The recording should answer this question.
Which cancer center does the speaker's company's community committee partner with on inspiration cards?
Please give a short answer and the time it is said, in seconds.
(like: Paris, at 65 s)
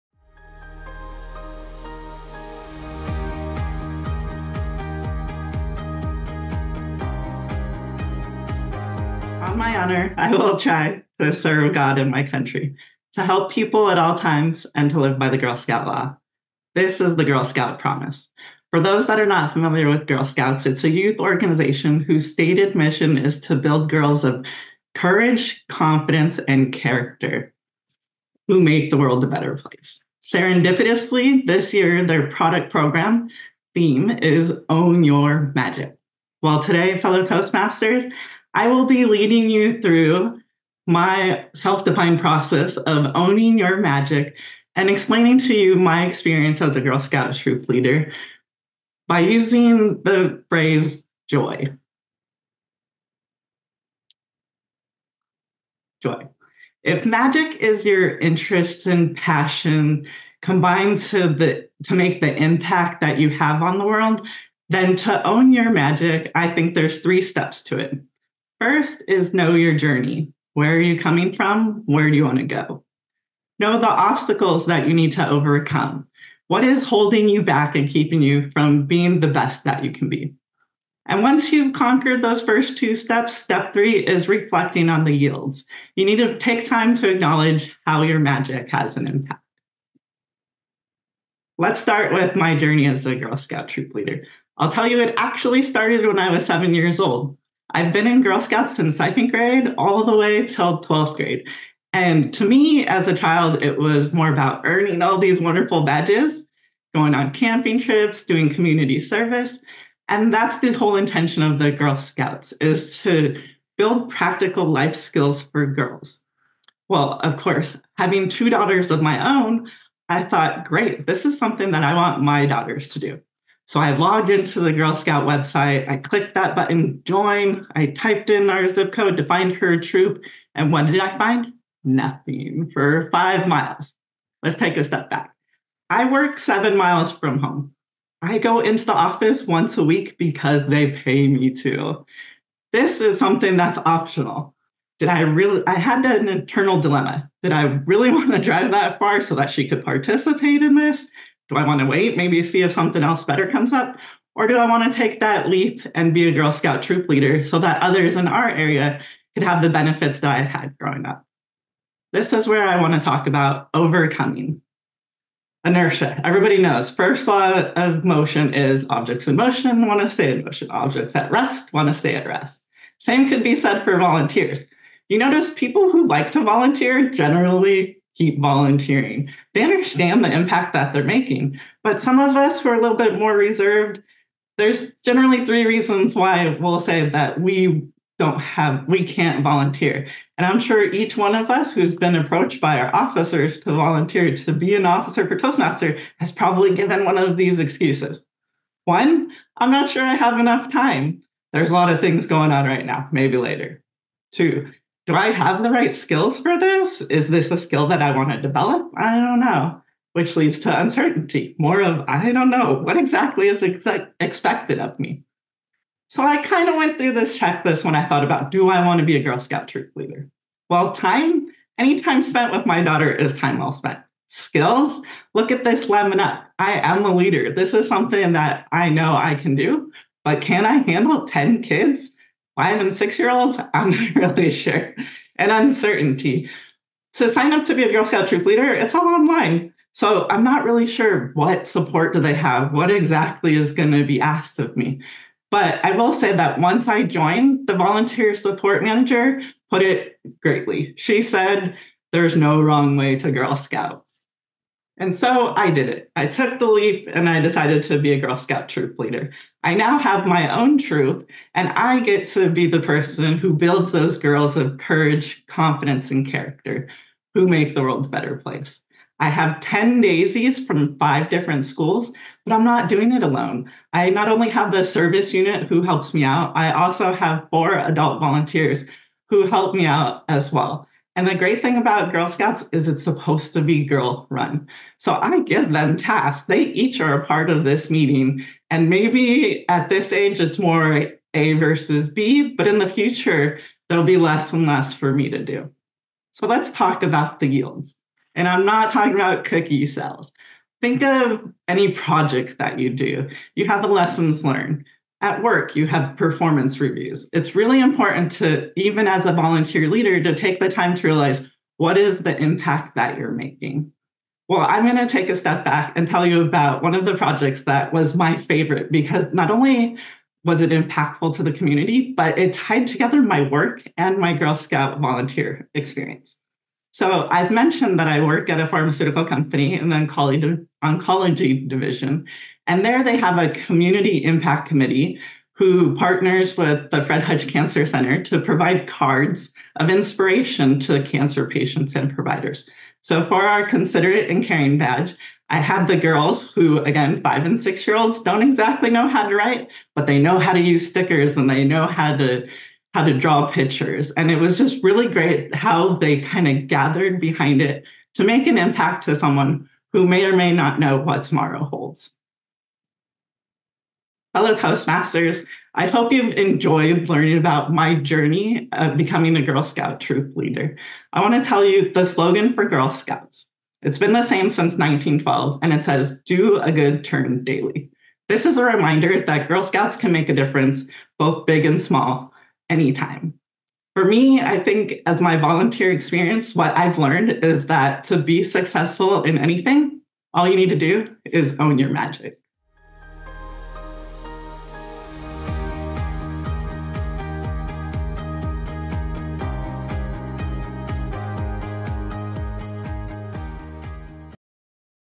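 Fred Hutch Cancer Center, at 337 s.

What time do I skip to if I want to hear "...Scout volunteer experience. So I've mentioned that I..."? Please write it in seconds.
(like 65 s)
324 s.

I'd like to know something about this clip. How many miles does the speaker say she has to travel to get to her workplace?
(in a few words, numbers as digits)
7.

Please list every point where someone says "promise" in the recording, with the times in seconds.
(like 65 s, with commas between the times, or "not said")
17 s.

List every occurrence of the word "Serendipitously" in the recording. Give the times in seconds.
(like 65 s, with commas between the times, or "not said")
30 s.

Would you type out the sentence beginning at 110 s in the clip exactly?
And that's the whole intention of the Girl Scouts is to build practical life skills for girls.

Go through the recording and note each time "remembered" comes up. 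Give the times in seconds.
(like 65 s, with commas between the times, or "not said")
not said.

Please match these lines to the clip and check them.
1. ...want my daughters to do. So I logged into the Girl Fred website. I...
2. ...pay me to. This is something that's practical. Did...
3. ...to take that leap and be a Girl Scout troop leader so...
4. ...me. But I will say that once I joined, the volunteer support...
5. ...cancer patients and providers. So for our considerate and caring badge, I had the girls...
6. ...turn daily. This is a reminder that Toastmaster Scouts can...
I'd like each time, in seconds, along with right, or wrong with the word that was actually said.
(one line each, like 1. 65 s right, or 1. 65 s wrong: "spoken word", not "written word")
1. 121 s wrong: "Scout", not "Fred"
2. 140 s wrong: "optional", not "practical"
3. 154 s right
4. 244 s right
5. 341 s right
6. 377 s wrong: "Girl", not "Toastmaster".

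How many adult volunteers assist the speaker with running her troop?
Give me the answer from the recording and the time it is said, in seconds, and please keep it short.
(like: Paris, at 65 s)
4, at 277 s.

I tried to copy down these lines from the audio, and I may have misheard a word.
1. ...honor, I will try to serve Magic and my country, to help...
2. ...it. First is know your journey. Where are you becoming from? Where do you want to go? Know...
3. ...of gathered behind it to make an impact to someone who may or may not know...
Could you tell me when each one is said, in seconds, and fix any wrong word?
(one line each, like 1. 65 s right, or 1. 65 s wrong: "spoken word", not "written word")
1. 9 s wrong: "God", not "Magic"
2. 67 s wrong: "coming", not "becoming"
3. 356 s right.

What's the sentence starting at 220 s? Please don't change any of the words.
Well, time, any time spent with my daughter is time well spent.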